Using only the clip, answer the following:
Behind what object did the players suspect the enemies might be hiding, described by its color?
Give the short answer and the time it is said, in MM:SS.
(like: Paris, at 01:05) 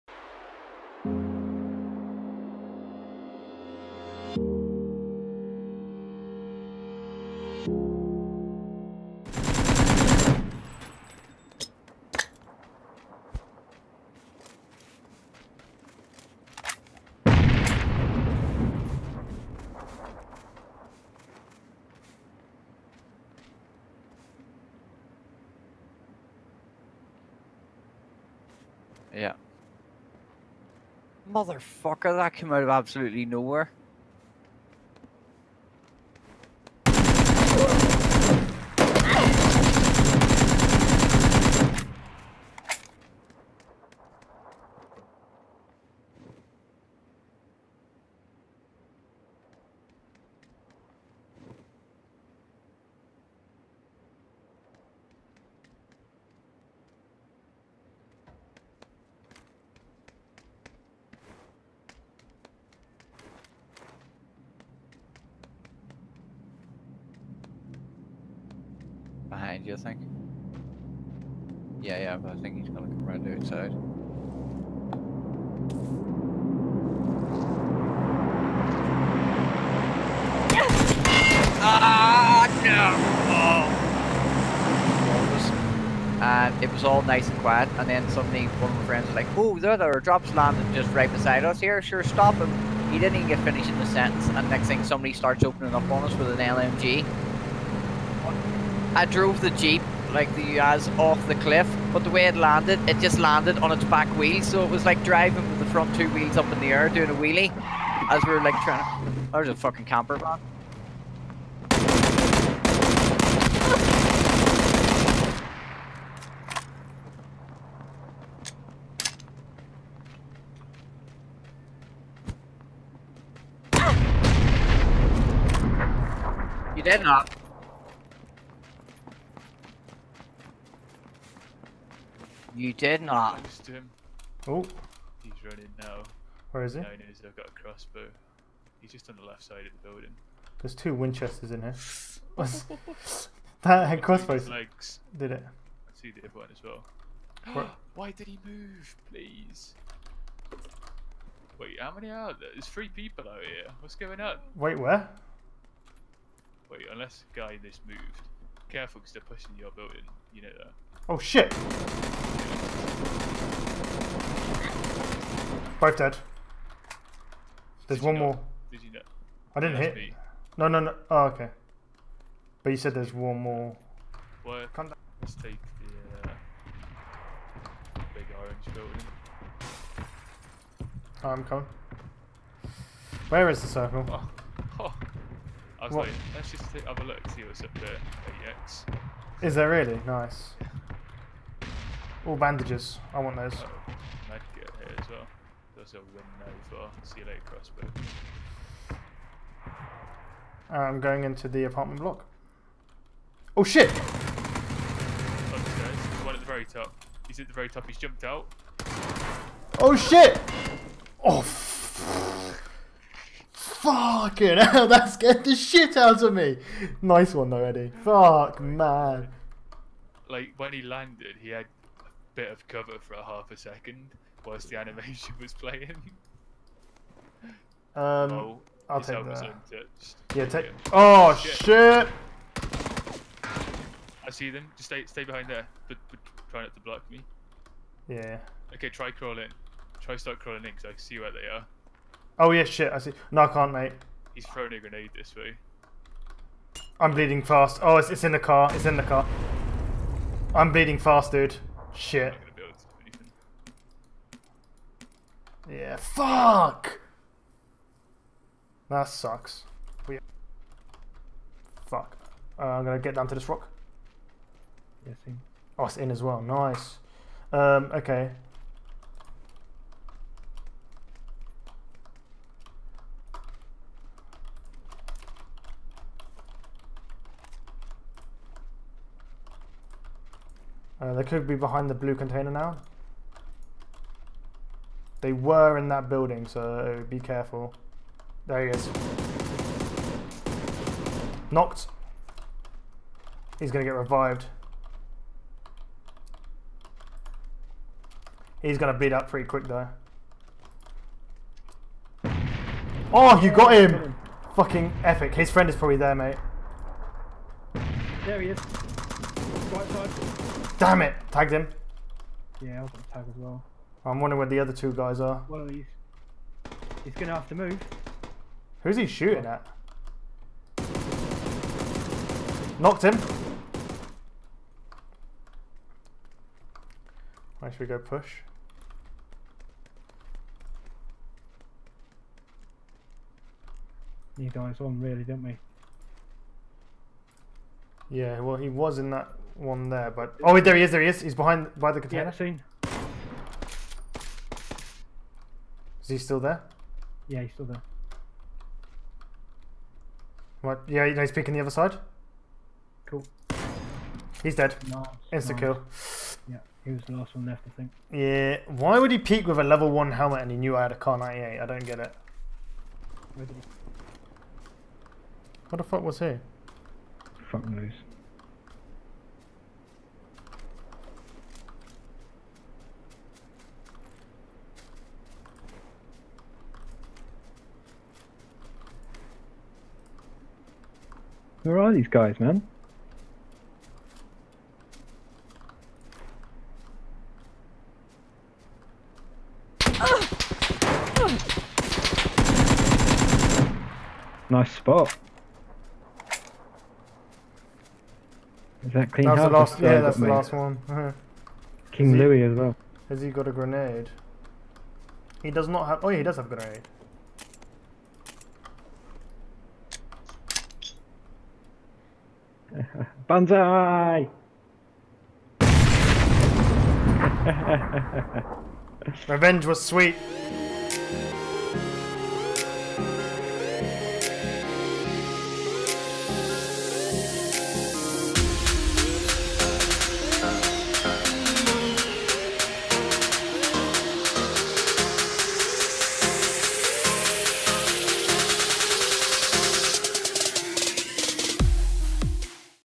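Blue container, at 04:41.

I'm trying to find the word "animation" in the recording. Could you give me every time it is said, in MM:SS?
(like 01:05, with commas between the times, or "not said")
03:44.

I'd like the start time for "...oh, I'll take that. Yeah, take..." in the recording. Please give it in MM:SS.
03:48.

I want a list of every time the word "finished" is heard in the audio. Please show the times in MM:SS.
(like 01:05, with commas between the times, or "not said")
01:33.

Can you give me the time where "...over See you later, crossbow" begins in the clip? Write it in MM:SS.
03:16.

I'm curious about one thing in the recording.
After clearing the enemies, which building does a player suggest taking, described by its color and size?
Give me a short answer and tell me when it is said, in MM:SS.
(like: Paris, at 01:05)
Big orange building, at 02:58.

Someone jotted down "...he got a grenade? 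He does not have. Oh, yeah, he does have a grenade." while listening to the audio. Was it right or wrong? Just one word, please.
right.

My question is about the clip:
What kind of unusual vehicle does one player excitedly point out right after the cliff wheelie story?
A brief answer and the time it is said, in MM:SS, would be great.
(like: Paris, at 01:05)
Camper van, at 01:49.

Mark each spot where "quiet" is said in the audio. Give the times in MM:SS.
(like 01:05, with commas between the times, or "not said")
01:27.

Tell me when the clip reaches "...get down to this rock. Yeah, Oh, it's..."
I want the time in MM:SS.
04:22.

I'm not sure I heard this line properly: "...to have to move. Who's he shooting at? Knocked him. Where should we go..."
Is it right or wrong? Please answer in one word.
right.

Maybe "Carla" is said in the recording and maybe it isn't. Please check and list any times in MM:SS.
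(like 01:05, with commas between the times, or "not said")
not said.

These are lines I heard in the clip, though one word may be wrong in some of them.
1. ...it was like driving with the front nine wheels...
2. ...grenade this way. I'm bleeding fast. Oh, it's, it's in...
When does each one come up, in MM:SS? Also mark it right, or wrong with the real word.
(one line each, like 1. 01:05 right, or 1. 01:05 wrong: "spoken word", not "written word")
1. 01:44 wrong: "two", not "nine"
2. 04:04 right.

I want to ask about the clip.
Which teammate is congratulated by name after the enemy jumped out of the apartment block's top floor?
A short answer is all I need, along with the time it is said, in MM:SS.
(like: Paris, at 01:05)
Eddie, at 03:37.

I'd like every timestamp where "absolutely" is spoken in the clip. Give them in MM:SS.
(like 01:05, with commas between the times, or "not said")
00:32.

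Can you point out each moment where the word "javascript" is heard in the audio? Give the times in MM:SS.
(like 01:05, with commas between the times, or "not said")
not said.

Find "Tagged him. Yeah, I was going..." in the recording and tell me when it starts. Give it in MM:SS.
05:11.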